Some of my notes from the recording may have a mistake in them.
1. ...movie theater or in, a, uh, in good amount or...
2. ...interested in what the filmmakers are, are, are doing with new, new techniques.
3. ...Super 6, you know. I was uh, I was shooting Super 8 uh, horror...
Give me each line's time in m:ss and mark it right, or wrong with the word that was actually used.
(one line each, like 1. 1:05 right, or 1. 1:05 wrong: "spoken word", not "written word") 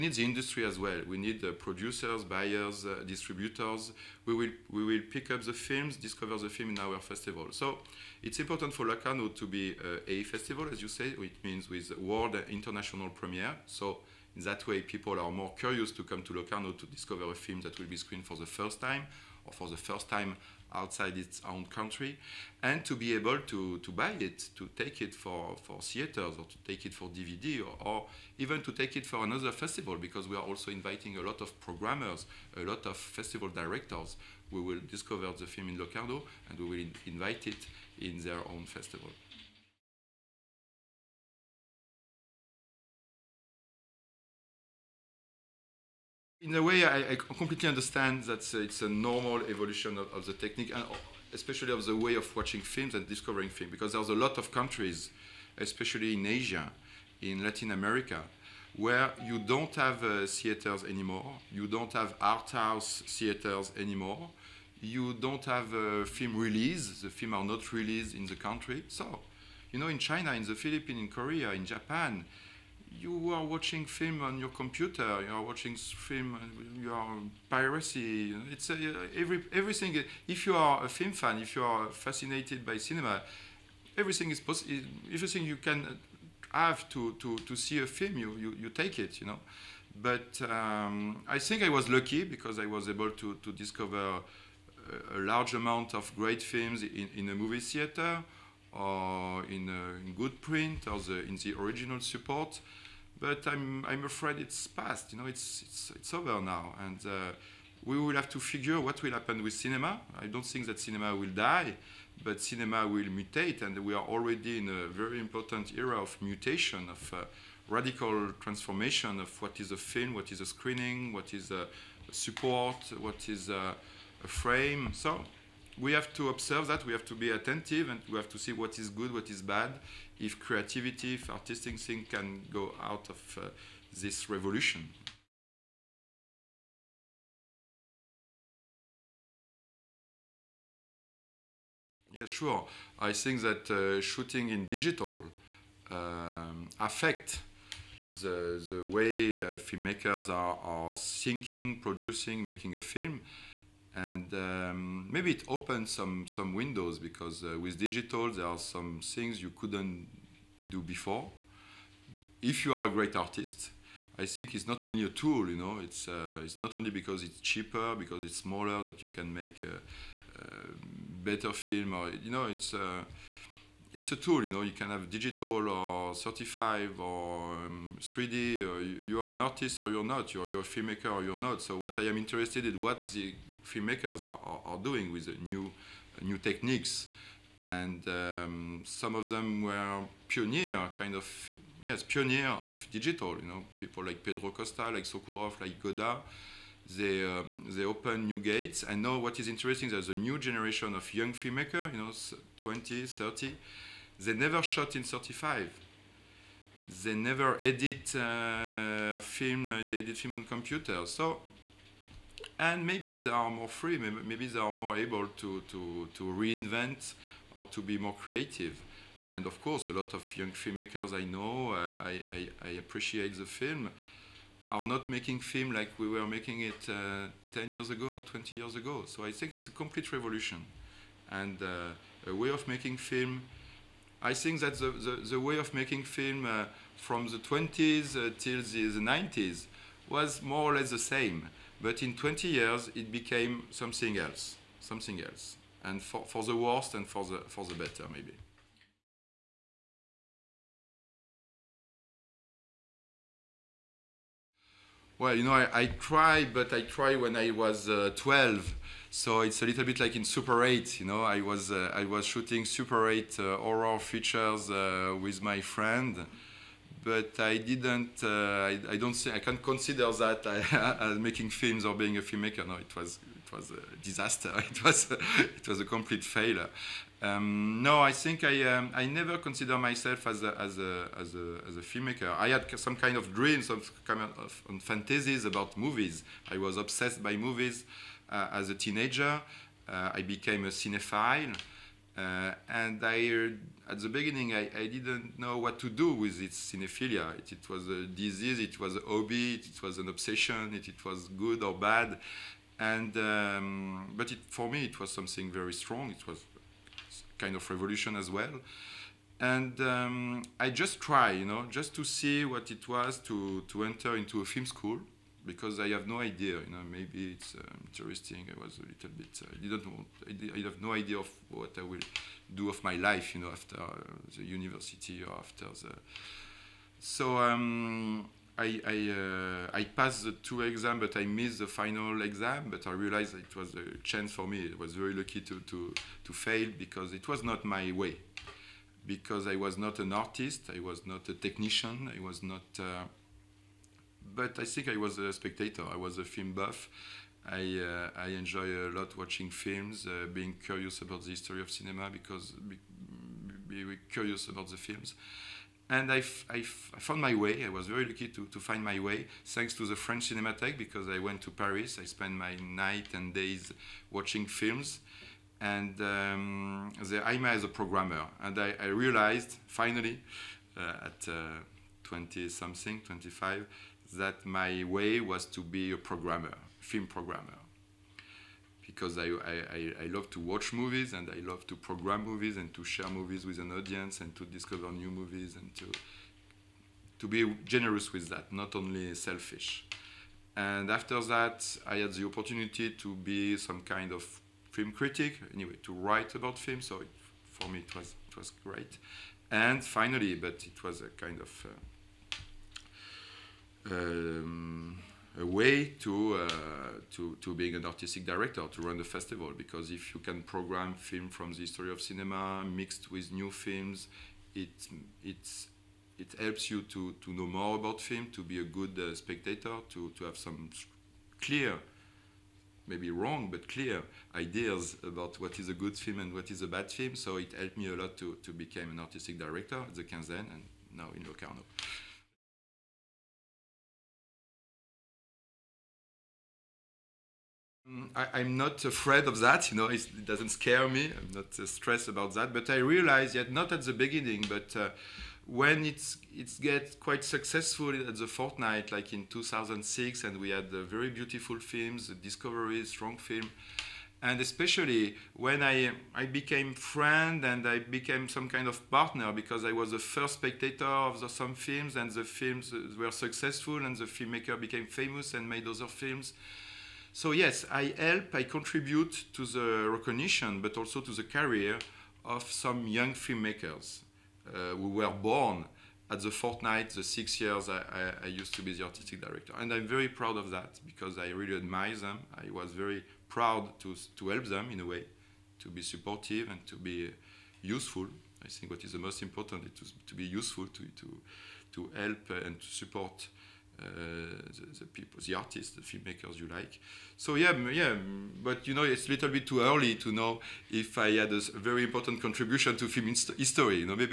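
1. 1:37 wrong: "print", not "amount"
2. 3:02 right
3. 4:20 wrong: "8", not "6".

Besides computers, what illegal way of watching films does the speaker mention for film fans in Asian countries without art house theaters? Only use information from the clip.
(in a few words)
Piracy.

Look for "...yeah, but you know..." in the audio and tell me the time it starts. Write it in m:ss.
8:17.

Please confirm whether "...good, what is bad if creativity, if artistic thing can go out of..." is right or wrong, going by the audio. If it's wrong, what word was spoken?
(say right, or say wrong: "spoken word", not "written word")
right.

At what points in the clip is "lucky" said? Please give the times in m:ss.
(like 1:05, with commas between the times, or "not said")
1:31, 5:35, 5:58.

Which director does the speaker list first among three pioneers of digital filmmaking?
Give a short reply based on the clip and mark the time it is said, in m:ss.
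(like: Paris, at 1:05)
Pedro Costa, at 3:14.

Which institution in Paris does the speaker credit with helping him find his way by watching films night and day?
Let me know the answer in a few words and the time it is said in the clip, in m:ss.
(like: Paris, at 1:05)
French Cinematheque, at 5:59.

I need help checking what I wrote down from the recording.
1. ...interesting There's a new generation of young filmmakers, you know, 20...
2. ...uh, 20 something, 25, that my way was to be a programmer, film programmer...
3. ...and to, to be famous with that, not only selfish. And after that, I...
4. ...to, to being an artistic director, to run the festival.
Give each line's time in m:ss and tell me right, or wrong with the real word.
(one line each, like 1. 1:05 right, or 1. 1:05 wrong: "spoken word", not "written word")
1. 3:19 right
2. 6:11 right
3. 6:25 wrong: "generous", not "famous"
4. 6:47 right.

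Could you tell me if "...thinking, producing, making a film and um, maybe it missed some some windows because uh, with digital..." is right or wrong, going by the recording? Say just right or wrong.
wrong.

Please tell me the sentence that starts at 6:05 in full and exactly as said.
And um, there I met a programmer.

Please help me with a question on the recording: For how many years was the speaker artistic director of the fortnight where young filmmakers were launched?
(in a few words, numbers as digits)
6.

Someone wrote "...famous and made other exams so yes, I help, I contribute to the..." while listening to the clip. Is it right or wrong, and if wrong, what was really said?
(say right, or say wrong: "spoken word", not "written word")
wrong: "films", not "exams".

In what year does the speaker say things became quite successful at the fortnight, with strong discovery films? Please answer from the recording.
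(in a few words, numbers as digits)
2006.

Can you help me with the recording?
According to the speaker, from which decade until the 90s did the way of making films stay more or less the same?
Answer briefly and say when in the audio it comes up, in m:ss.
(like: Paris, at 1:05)
The 20s, at 3:57.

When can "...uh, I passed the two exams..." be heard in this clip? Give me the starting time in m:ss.
5:29.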